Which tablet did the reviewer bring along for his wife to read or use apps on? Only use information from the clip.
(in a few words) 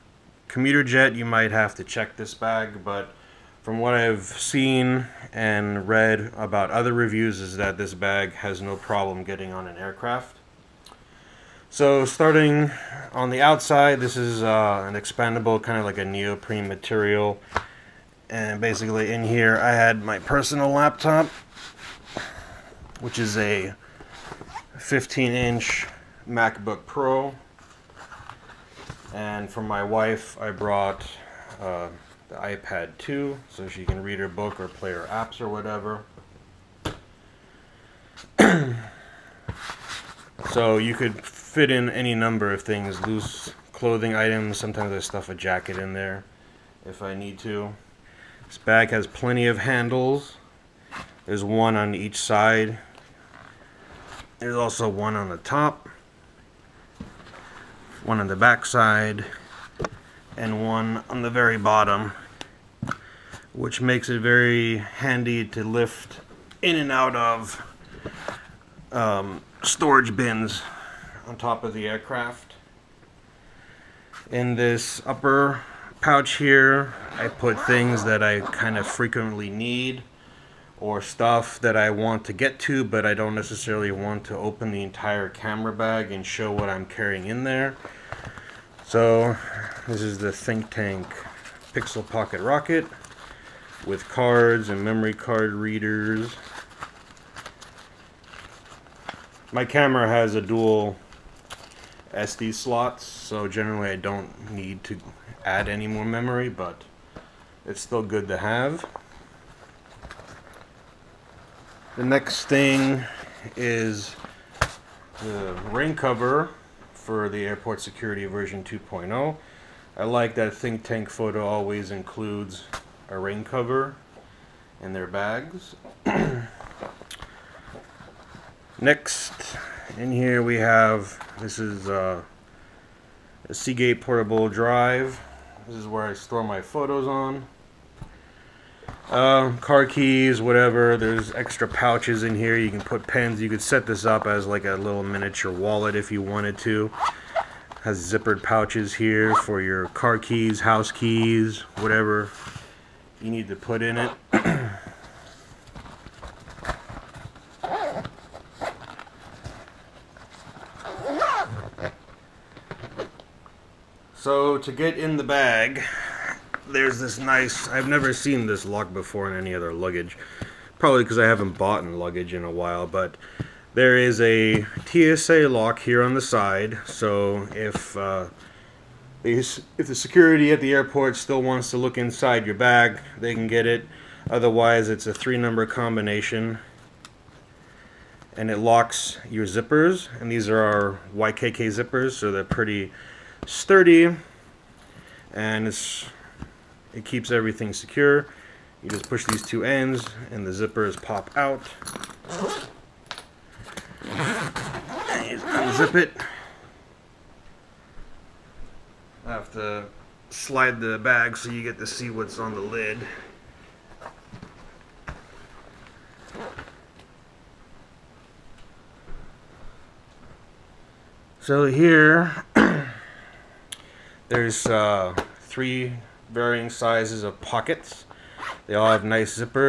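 iPad 2.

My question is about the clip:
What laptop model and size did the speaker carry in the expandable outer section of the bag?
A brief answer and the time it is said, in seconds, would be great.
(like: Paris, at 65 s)
15-inch MacBook Pro, at 24 s.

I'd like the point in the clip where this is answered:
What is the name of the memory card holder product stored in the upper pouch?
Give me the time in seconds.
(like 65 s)
91 s.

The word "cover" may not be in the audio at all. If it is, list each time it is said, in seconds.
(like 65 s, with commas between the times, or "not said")
115 s, 123 s.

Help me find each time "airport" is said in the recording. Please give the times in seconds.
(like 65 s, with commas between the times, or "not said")
117 s, 180 s.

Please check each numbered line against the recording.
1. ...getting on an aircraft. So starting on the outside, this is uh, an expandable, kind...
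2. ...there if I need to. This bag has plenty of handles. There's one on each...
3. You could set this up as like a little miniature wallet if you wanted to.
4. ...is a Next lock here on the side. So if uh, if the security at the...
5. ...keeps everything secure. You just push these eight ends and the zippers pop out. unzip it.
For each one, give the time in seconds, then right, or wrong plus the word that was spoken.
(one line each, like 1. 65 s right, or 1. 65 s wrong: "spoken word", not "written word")
1. 9 s right
2. 45 s right
3. 143 s right
4. 173 s wrong: "TSA", not "Next"
5. 197 s wrong: "two", not "eight".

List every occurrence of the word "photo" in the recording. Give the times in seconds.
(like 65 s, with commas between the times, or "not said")
121 s, 136 s.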